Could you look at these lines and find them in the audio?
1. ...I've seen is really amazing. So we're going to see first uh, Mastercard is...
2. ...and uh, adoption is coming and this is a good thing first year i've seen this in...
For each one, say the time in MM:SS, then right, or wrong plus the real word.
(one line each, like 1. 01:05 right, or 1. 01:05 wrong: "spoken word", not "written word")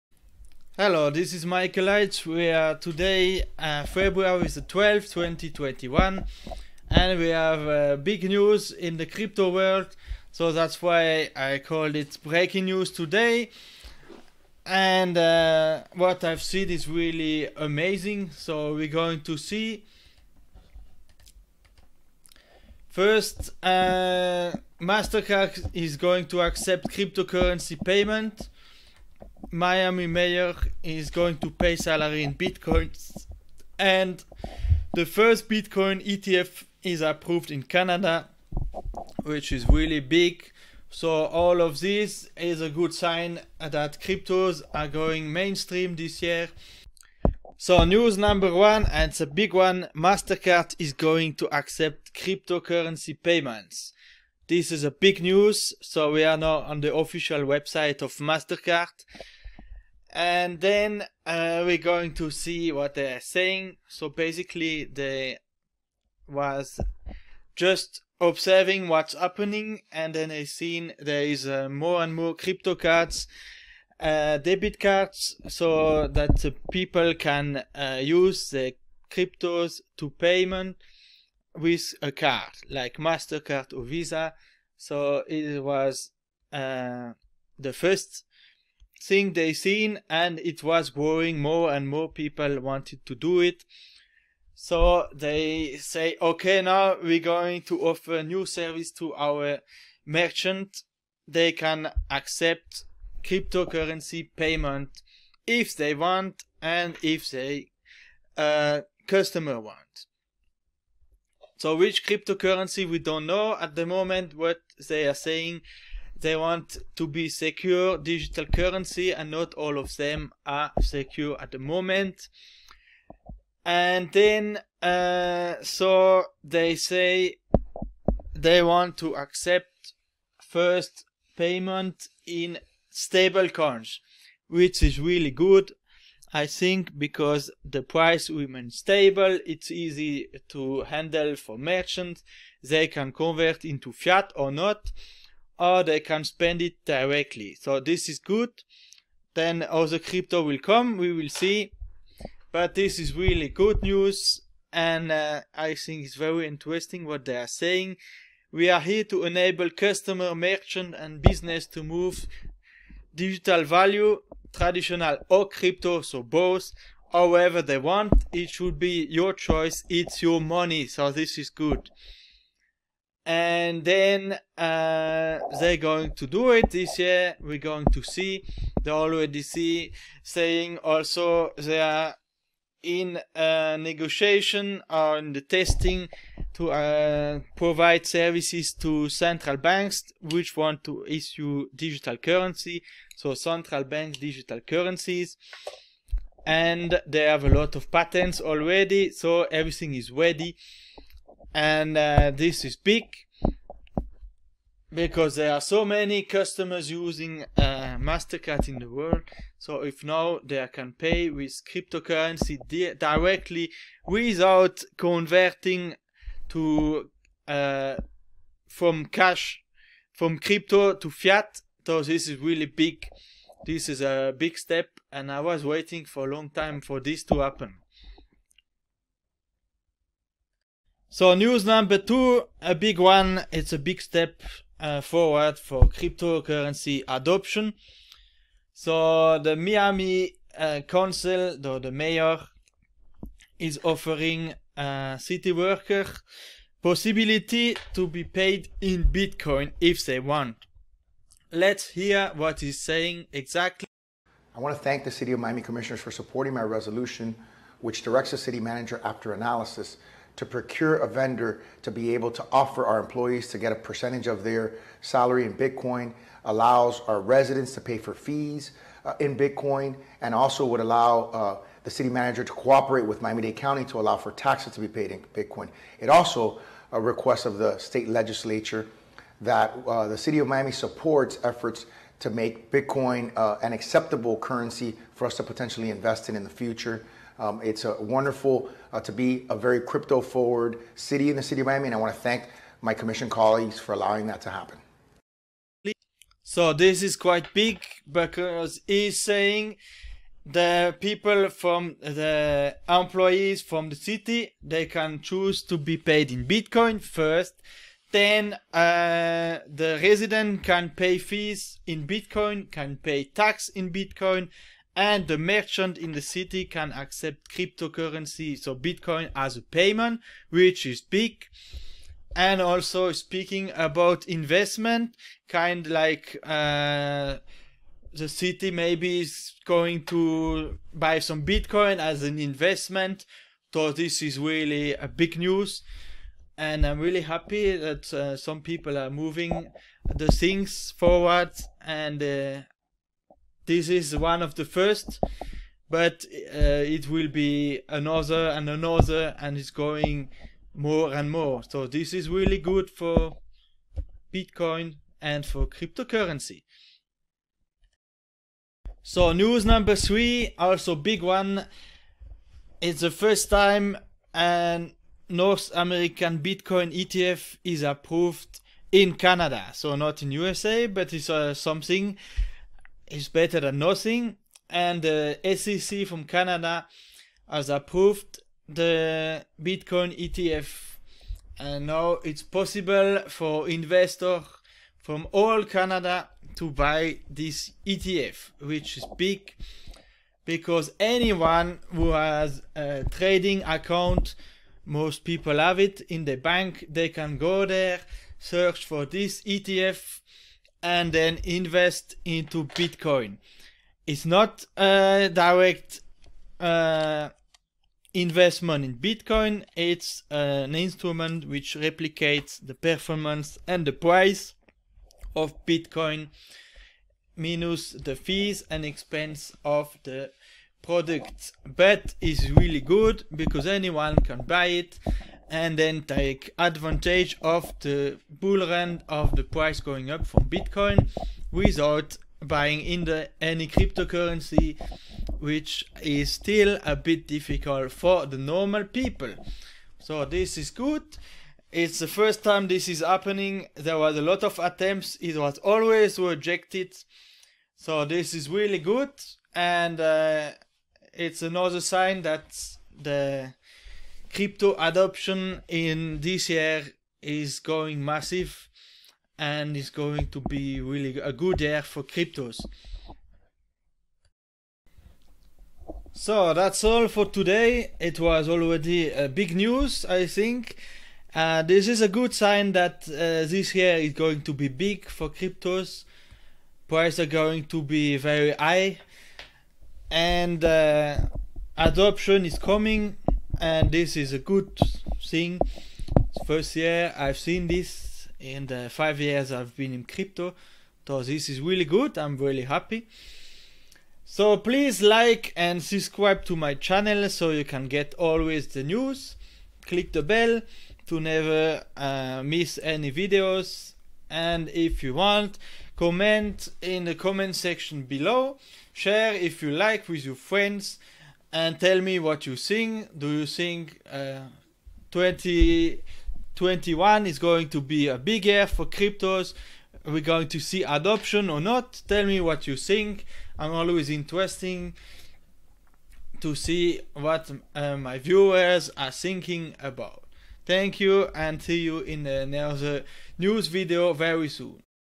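1. 00:16 right
2. 08:00 right.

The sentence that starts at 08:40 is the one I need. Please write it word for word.
Are we going to see adoption or not?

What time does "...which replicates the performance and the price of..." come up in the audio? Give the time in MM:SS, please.
06:51.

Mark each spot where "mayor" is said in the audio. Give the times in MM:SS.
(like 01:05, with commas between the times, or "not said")
00:30, 04:01.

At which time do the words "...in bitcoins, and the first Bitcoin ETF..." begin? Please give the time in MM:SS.
00:32.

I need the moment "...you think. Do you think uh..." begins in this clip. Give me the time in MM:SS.
08:32.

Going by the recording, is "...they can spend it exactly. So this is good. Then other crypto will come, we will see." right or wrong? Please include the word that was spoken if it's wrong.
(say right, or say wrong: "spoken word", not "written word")
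wrong: "directly", not "exactly".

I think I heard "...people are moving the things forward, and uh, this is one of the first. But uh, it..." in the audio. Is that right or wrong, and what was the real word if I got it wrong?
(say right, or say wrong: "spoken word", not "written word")
right.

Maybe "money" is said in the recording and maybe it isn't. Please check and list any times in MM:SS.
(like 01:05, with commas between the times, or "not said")
02:50.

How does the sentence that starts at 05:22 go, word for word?
And also speaking about investment, kind like uh, the city maybe is going to buy some Bitcoin as an investment.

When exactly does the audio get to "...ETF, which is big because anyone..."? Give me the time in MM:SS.
06:27.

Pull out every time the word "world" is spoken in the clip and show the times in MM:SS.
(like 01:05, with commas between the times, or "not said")
00:09, 03:28.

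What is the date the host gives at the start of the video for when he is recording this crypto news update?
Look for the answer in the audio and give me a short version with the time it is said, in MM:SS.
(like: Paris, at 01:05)
February 12, 2021, at 00:03.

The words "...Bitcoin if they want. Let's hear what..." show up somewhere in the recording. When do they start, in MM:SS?
04:09.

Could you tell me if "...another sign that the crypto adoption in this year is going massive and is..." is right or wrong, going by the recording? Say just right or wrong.
right.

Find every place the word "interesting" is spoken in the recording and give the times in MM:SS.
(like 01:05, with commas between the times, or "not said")
02:36, 08:44.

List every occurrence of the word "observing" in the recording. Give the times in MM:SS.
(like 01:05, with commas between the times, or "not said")
01:08.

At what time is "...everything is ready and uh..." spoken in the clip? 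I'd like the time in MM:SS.
03:19.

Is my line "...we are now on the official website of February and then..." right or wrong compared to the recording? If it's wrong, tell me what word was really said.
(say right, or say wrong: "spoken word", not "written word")
wrong: "MasterCard", not "February".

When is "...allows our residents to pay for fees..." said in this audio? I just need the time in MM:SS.
04:26.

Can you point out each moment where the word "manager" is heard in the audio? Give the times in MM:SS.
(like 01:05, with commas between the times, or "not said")
04:18, 04:32.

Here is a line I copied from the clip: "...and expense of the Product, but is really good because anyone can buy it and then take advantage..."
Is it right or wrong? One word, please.
right.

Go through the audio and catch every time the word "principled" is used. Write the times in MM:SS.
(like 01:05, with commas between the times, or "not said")
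not said.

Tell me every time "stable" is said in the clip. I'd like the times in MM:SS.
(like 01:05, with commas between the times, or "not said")
02:12, 02:18.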